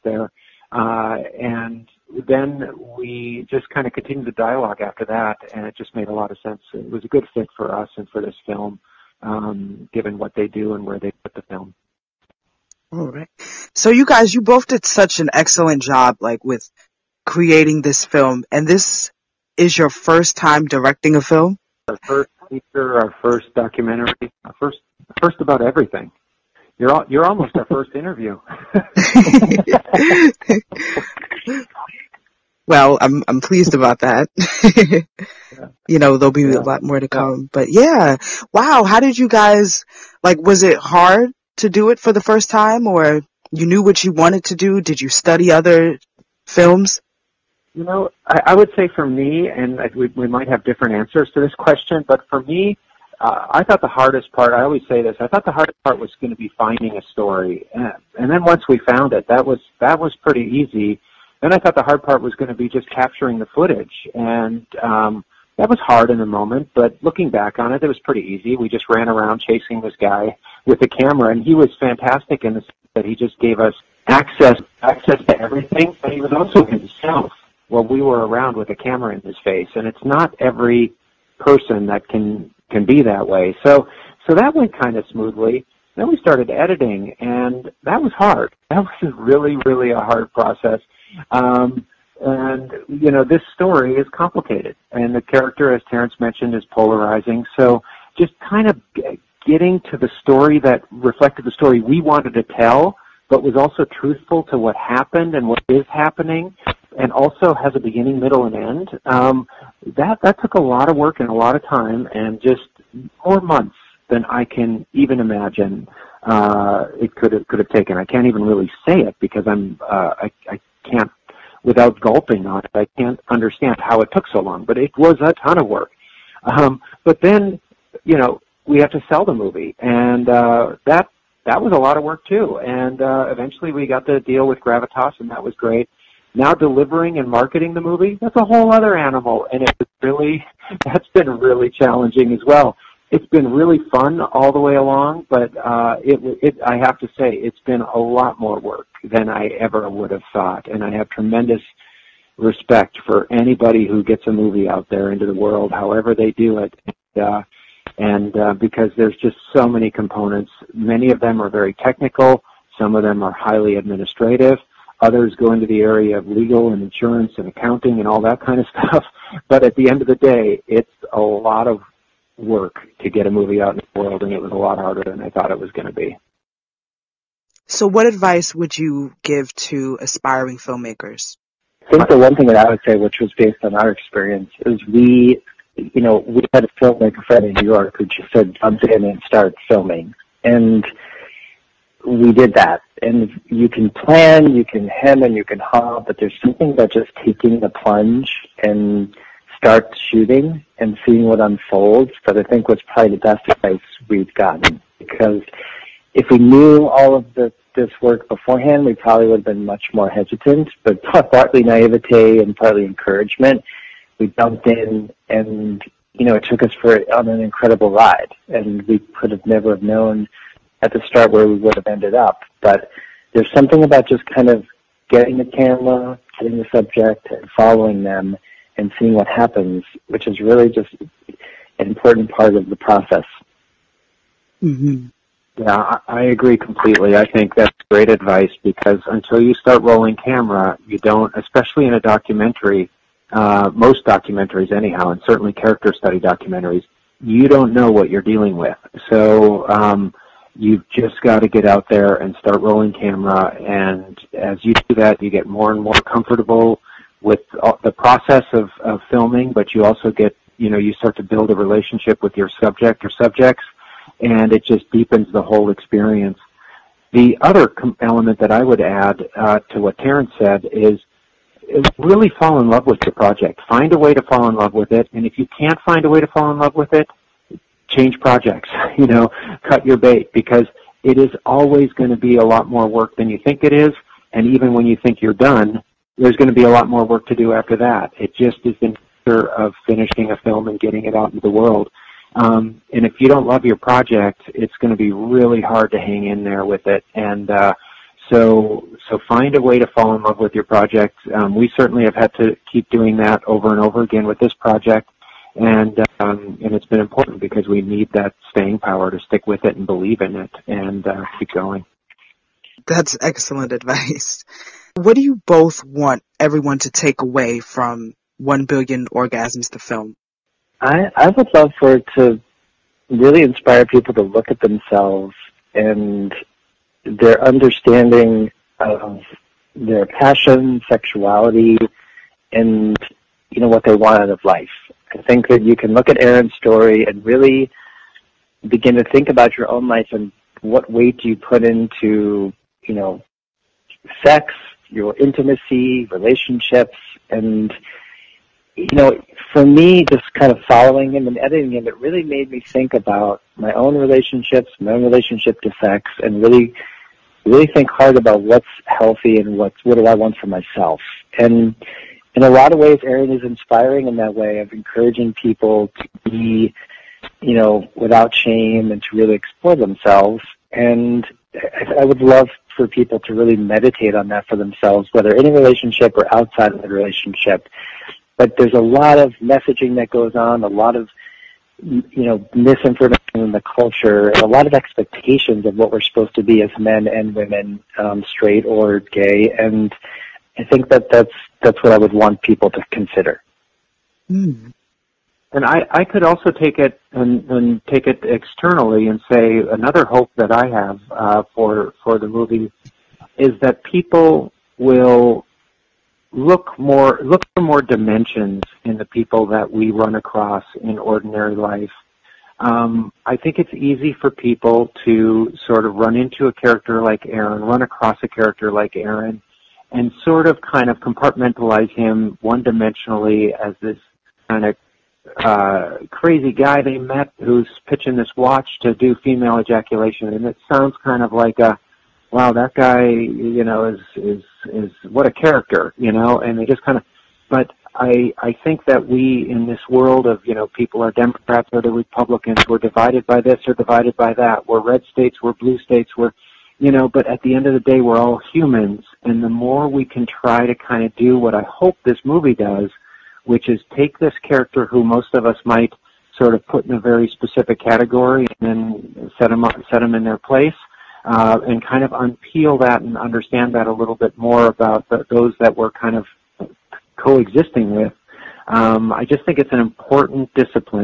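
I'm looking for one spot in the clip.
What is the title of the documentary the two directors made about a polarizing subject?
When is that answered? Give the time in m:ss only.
5:18.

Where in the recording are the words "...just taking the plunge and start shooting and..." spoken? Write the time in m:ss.
3:16.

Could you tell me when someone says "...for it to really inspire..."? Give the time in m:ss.
5:21.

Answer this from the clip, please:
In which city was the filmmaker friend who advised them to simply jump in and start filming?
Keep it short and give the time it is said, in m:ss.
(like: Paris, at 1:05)
New York, at 3:07.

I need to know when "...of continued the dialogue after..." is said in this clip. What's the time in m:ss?
0:03.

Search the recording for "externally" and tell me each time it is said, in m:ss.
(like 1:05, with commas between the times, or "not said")
6:38.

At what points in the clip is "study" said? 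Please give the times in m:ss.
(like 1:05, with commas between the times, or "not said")
0:45, 4:05.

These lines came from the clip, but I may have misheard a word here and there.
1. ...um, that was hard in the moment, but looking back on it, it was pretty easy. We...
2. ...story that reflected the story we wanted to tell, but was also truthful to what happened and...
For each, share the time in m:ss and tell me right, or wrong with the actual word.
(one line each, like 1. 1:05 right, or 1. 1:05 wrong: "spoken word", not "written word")
1. 1:04 right
2. 1:40 right.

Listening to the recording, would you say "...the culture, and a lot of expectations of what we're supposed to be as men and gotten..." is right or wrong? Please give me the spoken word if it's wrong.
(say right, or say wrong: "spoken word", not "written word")
wrong: "women", not "gotten".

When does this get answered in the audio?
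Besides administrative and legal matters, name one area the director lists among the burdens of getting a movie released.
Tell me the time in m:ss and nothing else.
2:46.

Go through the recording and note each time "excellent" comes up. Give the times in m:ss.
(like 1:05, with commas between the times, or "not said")
0:15, 5:13.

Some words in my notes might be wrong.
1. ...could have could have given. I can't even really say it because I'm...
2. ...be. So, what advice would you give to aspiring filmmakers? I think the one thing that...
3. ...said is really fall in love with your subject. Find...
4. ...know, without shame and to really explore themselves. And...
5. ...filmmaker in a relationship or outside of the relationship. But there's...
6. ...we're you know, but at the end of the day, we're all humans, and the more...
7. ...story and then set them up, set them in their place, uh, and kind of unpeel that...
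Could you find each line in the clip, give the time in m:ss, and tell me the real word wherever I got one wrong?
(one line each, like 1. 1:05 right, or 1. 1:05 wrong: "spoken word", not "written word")
1. 1:57 wrong: "taken", not "given"
2. 2:55 right
3. 4:30 wrong: "project", not "subject"
4. 6:07 right
5. 6:15 wrong: "whether", not "filmmaker"
6. 7:26 right
7. 7:37 wrong: "category", not "story".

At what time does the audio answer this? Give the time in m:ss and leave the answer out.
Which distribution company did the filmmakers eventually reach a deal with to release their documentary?
2:14.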